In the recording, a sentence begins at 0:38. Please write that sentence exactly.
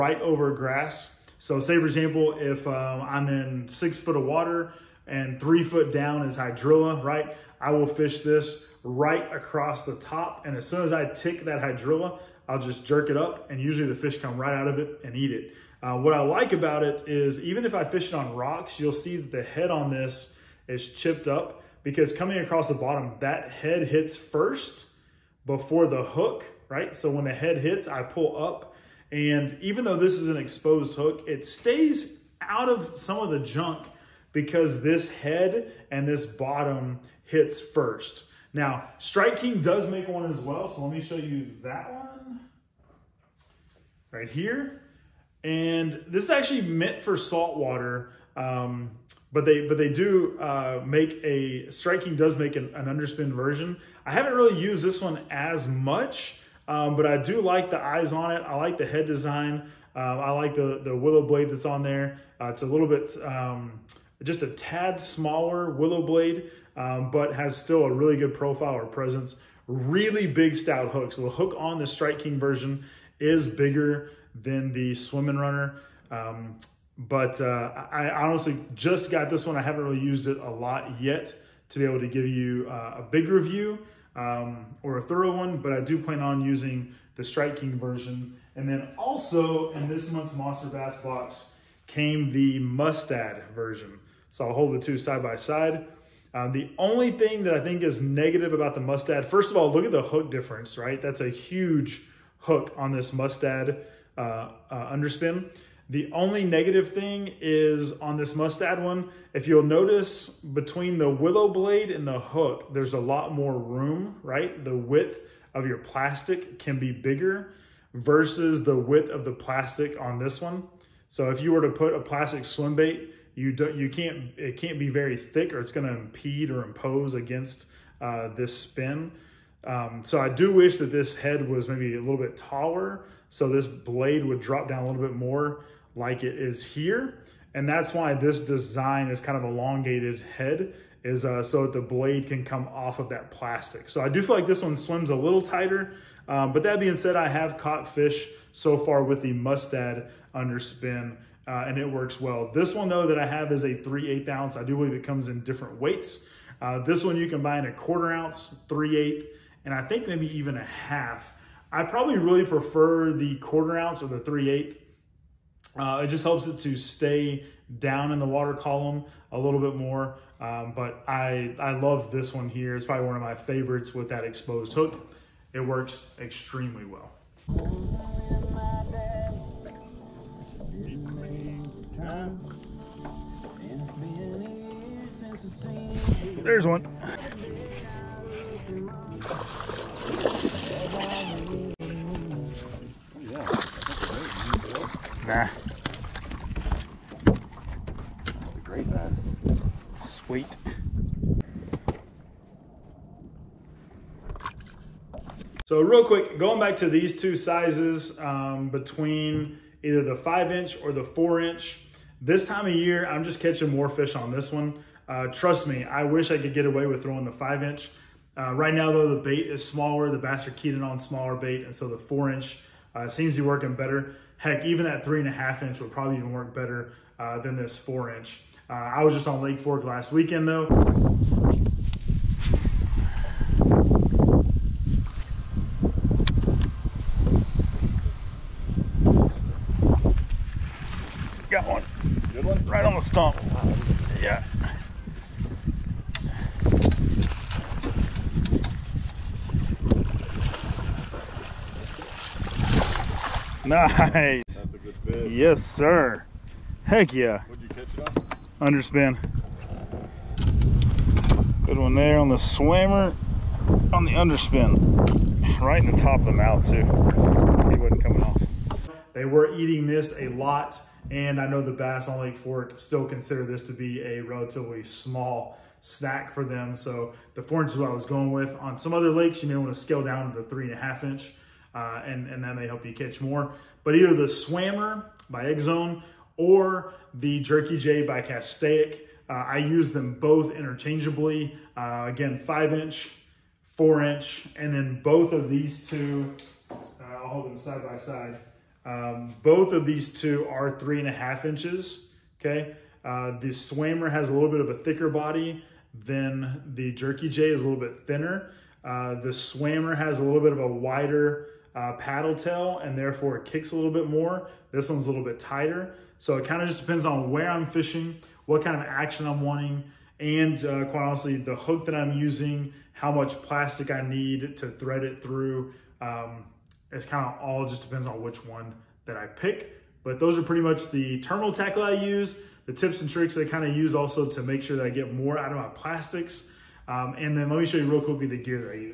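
Now, Strike King does make one as well.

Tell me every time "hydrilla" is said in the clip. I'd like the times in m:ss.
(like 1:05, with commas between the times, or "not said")
0:06, 0:11.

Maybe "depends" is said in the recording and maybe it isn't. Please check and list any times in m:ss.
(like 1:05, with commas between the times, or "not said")
5:16, 5:27.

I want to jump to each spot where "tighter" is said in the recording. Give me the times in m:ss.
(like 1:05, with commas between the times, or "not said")
2:25, 5:15.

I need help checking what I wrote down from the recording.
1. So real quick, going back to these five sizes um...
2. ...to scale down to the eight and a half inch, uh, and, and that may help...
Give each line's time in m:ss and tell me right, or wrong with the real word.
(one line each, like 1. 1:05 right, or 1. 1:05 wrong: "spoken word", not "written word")
1. 3:25 wrong: "two", not "five"
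2. 4:39 wrong: "three", not "eight".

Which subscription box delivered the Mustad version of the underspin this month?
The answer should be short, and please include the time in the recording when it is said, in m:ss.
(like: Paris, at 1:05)
Monster Bass, at 1:30.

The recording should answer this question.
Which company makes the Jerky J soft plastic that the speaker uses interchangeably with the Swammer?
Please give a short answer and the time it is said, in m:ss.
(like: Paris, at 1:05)
Castaic, at 4:48.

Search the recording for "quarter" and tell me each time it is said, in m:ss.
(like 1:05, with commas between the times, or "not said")
2:37, 2:43.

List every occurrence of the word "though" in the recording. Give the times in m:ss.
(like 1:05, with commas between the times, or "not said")
0:29, 2:32, 3:38, 3:50.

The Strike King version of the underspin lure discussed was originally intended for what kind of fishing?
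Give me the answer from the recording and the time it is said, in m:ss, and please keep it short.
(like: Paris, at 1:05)
Saltwater, at 0:47.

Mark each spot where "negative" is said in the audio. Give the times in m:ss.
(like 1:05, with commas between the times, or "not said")
1:38, 1:46.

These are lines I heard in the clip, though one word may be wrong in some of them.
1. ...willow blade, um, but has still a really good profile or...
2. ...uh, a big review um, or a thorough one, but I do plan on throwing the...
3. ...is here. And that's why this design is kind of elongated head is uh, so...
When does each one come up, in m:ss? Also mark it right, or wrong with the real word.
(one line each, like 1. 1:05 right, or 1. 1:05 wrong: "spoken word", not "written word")
1. 1:05 right
2. 1:22 wrong: "using", not "throwing"
3. 2:16 right.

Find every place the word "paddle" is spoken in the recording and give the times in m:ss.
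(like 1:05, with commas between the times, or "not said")
5:11.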